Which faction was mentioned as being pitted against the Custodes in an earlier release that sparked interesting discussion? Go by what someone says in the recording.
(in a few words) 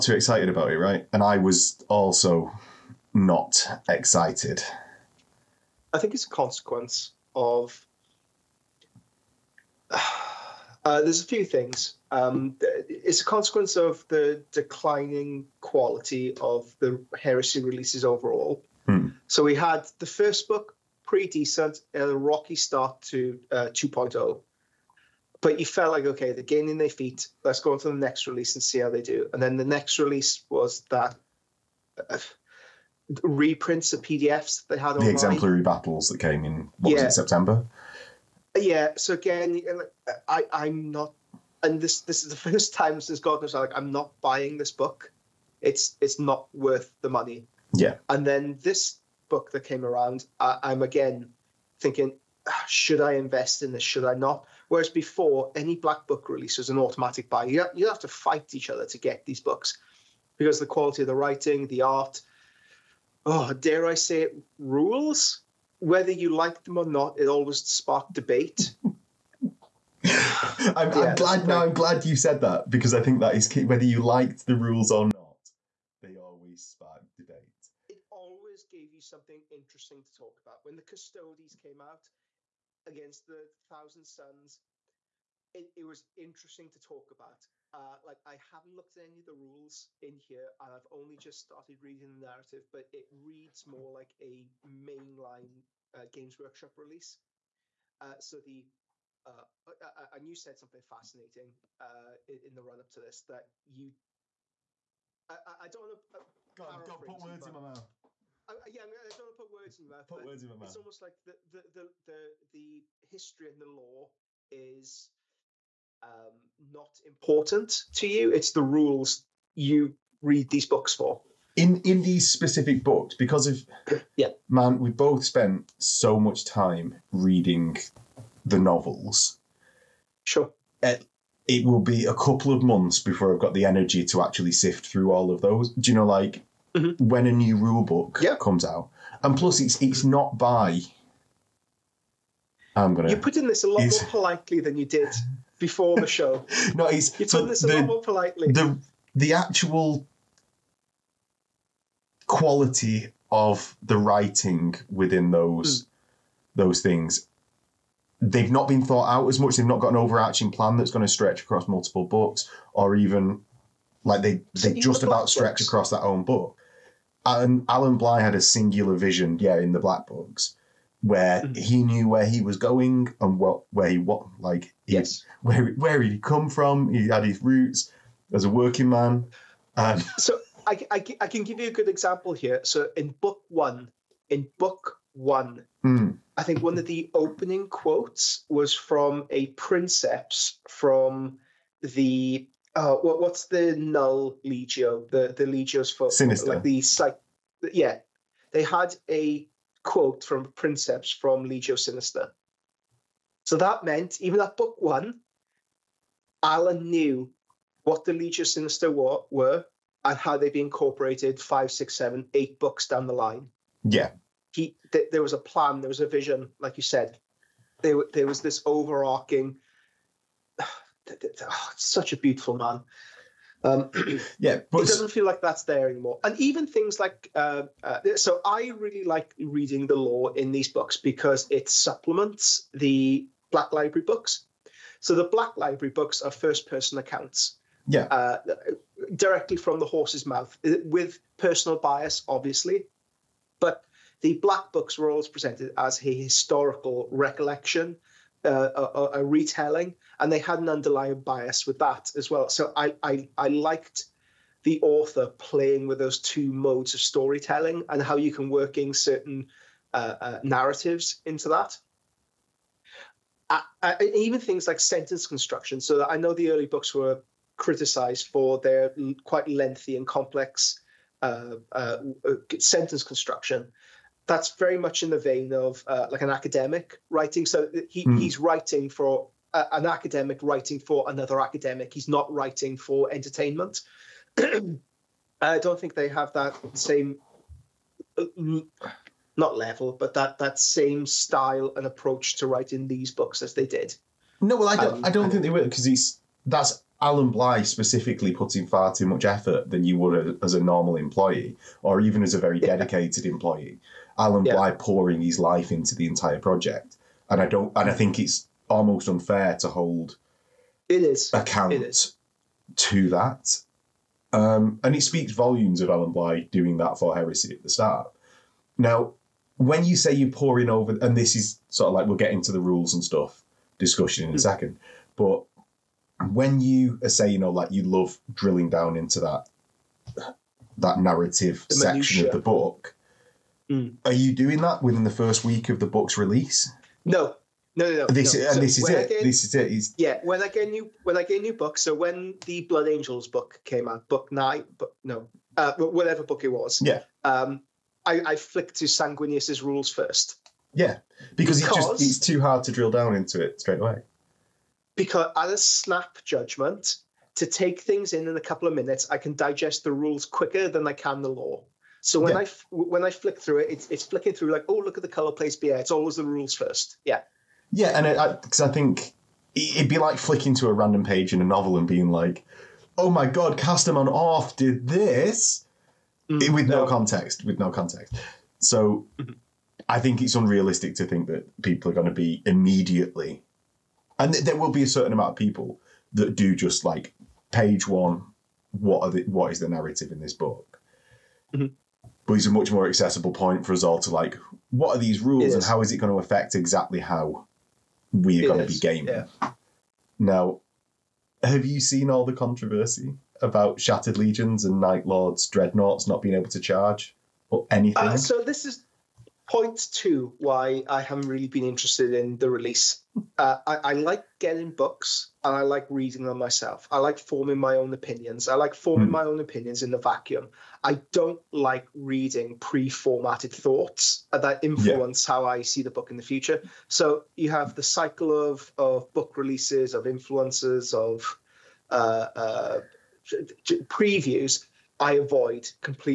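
Thousand Sons.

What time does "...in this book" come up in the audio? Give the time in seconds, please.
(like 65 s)
390 s.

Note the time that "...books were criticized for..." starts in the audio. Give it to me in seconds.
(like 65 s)
266 s.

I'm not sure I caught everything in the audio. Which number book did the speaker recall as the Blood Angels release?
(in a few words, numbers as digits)
9.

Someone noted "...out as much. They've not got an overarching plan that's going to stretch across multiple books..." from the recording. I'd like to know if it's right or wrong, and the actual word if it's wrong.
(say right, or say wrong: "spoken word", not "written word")
right.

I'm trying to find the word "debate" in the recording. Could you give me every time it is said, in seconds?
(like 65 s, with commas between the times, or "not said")
68 s, 77 s.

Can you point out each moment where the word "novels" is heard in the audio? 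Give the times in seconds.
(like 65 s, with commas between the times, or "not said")
128 s, 371 s.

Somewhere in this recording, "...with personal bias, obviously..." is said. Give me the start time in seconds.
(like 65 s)
240 s.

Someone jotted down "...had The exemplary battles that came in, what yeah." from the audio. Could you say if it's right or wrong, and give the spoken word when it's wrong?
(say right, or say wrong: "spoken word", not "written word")
right.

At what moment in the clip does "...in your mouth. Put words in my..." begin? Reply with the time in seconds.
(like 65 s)
109 s.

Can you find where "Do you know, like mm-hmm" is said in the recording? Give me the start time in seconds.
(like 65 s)
135 s.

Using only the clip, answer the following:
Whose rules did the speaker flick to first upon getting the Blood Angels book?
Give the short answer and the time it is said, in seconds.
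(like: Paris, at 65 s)
Sanguinius, at 348 s.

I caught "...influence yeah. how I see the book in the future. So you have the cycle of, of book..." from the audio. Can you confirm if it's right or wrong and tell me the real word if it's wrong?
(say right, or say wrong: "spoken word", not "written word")
right.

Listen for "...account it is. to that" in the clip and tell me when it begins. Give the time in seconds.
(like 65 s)
311 s.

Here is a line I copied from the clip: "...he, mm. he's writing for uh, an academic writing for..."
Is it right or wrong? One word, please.
right.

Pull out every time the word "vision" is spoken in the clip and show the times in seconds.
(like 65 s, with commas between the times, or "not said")
168 s, 216 s.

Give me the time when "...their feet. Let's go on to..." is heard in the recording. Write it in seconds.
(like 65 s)
26 s.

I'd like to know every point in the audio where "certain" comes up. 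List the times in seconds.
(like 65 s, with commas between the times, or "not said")
258 s, 384 s.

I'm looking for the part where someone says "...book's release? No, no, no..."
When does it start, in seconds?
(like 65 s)
335 s.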